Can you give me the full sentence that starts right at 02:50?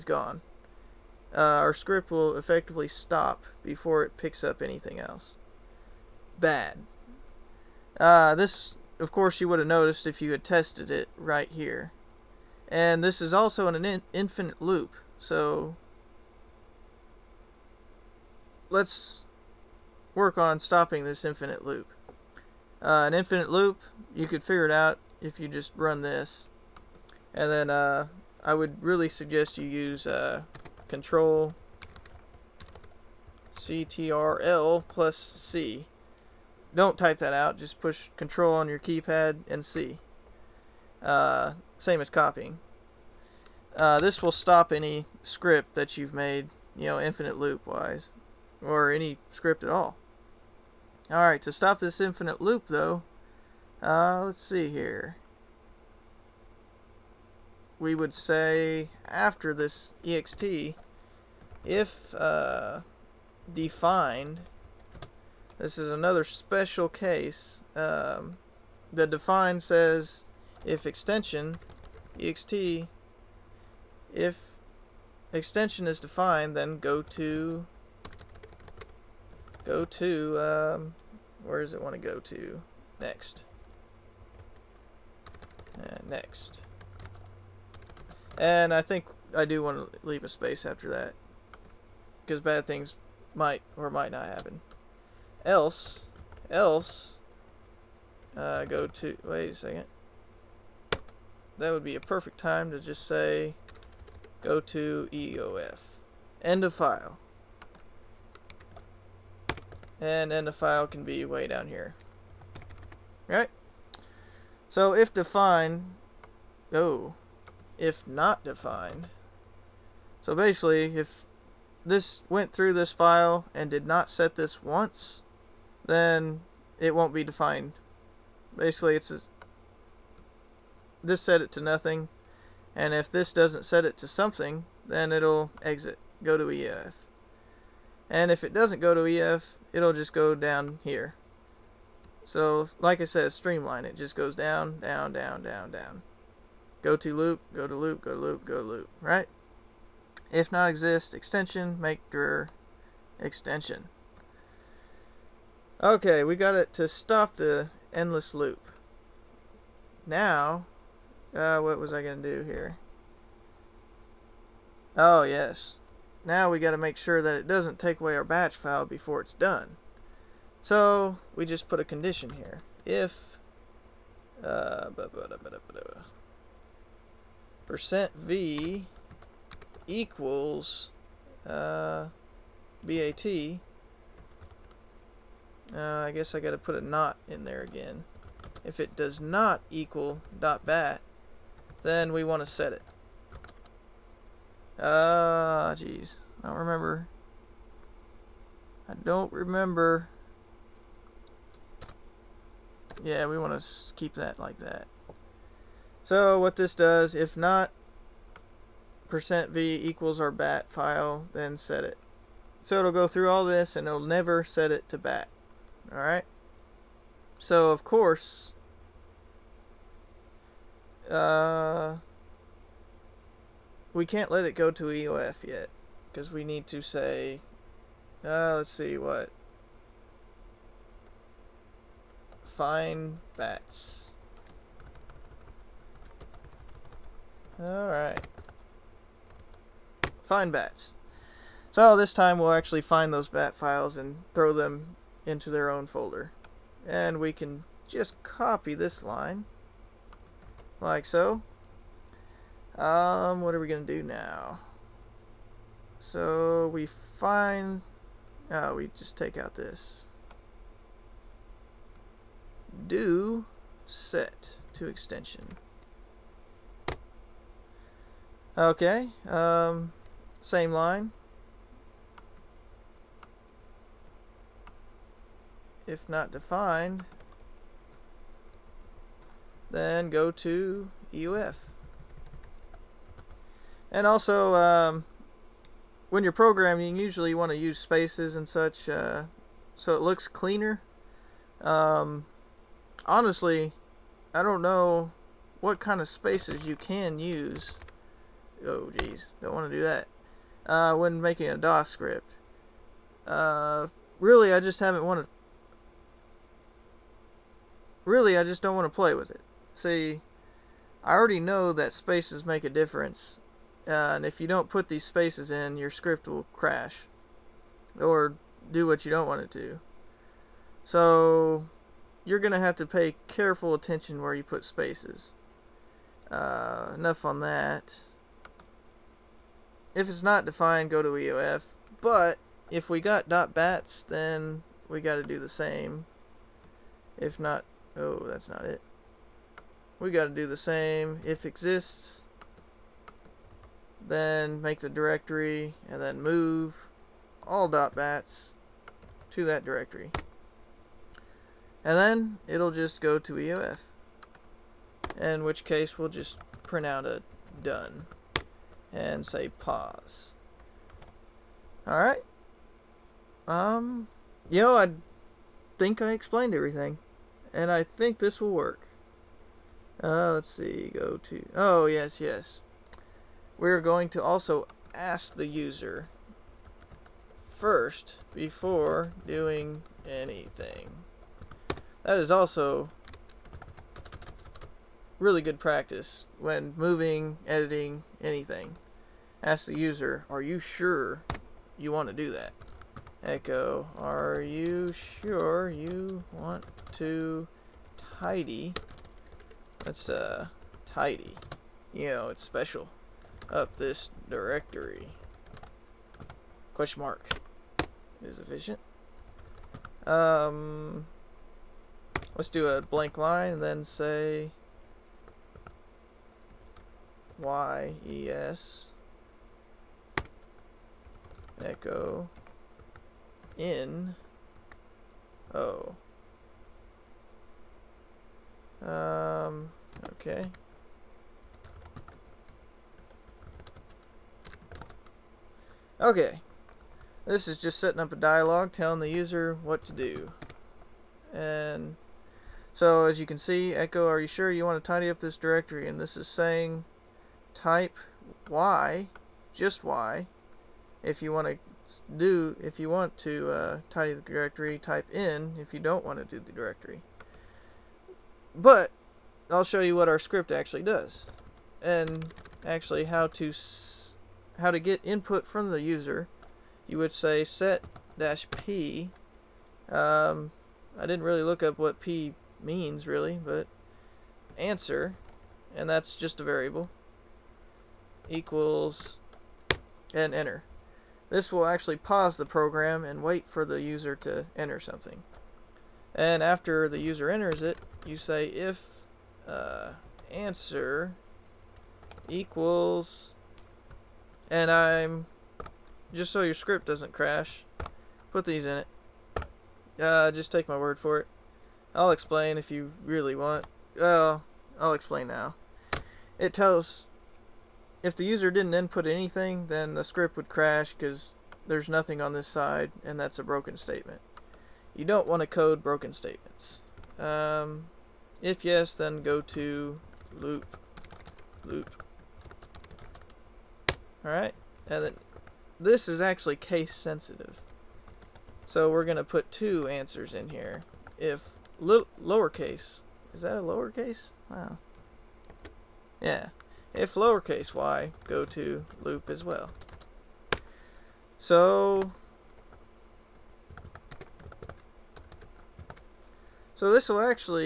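So we just put a condition here.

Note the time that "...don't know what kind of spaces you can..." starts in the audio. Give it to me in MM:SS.
04:54.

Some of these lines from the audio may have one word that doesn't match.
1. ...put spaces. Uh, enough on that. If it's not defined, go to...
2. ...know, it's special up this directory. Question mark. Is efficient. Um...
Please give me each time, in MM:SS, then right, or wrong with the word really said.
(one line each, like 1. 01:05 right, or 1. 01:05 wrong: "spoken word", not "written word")
1. 05:24 right
2. 06:42 right.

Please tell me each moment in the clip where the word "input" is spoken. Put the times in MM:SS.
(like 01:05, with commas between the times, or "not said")
07:45, 08:28.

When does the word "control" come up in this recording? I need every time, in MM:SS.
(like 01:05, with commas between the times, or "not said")
00:30, 00:38.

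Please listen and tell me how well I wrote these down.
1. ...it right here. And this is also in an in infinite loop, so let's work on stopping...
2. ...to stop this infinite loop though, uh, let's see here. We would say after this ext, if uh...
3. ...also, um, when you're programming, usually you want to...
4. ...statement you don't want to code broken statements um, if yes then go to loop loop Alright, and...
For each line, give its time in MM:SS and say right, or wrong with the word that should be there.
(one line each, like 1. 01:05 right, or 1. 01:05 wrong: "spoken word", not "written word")
1. 00:10 right
2. 00:51 right
3. 04:44 right
4. 08:33 right.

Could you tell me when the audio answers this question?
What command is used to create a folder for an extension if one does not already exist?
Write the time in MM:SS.
02:31.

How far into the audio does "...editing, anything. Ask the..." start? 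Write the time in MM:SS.
06:27.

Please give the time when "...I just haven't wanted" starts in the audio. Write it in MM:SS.
05:04.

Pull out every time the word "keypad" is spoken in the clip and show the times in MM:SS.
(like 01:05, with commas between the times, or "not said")
00:38.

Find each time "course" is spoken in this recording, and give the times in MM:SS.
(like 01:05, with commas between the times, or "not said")
00:09, 03:37.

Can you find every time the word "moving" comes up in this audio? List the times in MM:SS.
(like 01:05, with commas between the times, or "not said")
06:26.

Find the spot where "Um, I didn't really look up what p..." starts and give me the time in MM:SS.
07:49.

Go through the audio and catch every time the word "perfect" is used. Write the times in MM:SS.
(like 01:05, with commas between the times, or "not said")
01:42.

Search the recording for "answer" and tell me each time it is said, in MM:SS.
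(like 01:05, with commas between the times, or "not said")
07:54, 08:10, 08:49.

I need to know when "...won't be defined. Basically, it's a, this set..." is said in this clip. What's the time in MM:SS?
02:06.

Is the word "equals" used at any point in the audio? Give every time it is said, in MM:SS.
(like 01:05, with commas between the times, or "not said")
02:59, 03:09, 03:29, 07:58, 08:12.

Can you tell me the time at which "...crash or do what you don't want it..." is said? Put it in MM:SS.
05:16.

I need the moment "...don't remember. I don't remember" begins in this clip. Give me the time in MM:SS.
03:16.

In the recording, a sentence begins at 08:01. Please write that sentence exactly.
This will actually pause the program and wait for the user to enter something.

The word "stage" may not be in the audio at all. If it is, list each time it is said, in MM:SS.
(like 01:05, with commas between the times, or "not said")
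not said.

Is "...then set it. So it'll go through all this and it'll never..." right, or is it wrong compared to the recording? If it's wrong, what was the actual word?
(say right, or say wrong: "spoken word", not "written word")
right.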